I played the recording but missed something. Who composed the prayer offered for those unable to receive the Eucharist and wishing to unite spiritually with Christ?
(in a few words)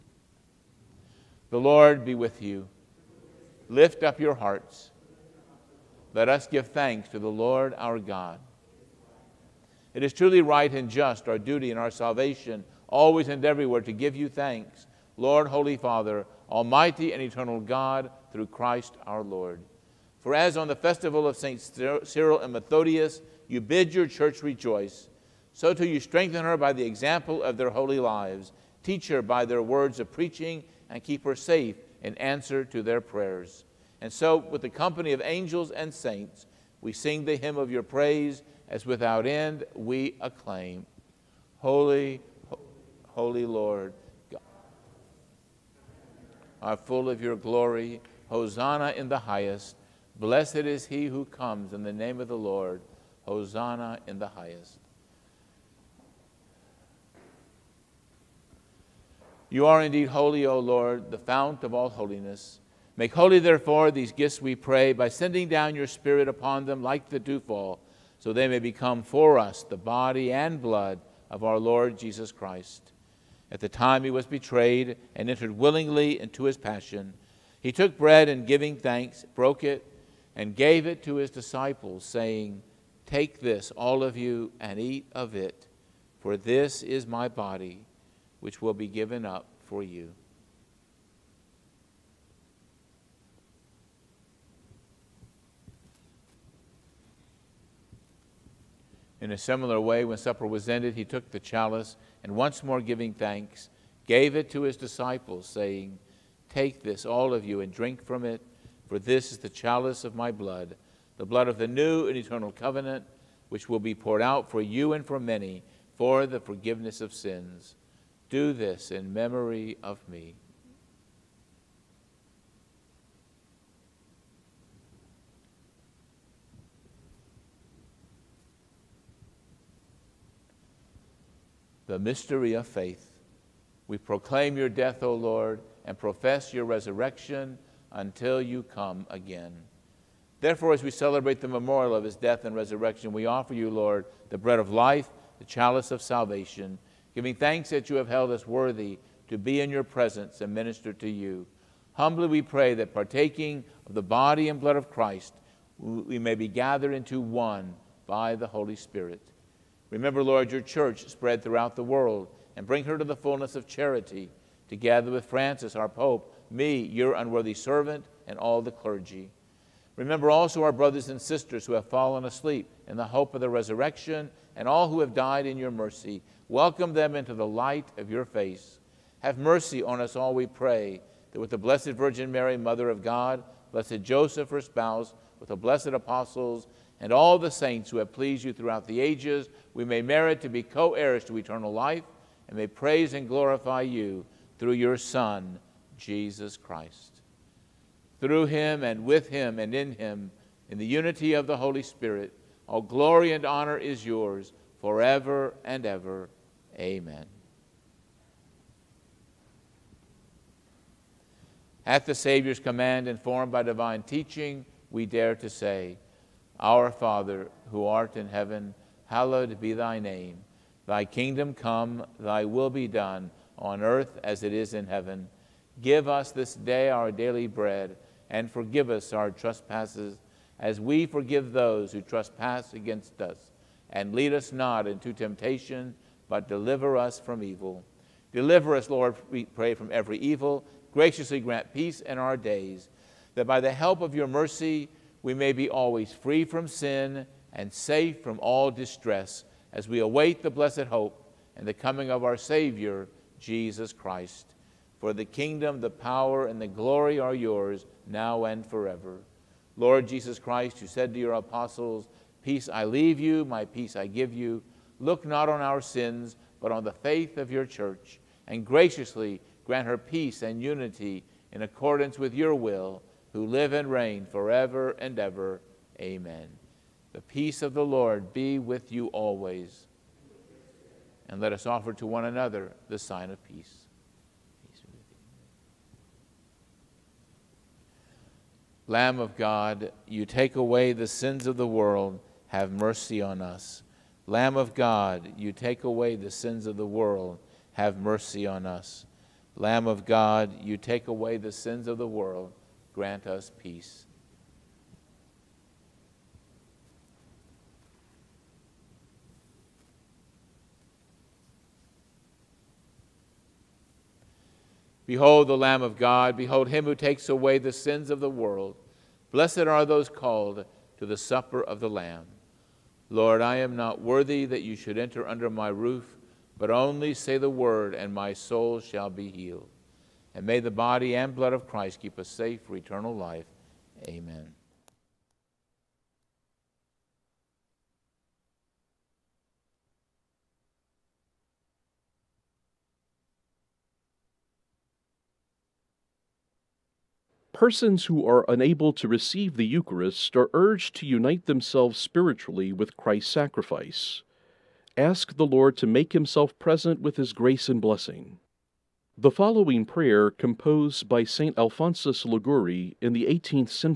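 St. Alphonsus Liguori.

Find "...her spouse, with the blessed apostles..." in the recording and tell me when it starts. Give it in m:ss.
3:04.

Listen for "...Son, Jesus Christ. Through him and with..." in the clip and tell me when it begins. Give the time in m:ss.
3:14.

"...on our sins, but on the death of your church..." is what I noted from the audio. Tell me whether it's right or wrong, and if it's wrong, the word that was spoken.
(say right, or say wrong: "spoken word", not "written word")
wrong: "faith", not "death".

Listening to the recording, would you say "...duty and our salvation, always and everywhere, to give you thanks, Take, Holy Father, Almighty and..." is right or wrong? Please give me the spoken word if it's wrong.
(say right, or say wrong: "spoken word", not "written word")
wrong: "Lord", not "Take".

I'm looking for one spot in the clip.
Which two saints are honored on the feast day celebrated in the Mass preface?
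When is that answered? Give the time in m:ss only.
0:21.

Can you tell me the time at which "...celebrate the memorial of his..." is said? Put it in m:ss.
2:20.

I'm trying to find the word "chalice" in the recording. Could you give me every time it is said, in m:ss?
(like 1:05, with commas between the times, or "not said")
1:41, 1:49, 2:25.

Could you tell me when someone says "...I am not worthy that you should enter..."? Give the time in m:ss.
5:23.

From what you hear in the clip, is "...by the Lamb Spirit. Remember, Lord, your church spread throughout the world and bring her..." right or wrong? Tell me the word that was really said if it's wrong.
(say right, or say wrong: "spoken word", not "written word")
wrong: "Holy", not "Lamb".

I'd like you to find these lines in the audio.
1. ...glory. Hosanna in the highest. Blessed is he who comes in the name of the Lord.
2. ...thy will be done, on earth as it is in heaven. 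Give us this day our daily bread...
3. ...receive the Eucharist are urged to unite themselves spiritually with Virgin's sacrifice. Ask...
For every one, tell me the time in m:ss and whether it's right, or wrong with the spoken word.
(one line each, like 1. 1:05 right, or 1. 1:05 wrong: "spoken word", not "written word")
1. 0:47 right
2. 3:42 right
3. 5:49 wrong: "Christ", not "Virgin".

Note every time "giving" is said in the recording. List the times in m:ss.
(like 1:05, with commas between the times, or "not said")
1:18, 1:42, 2:27.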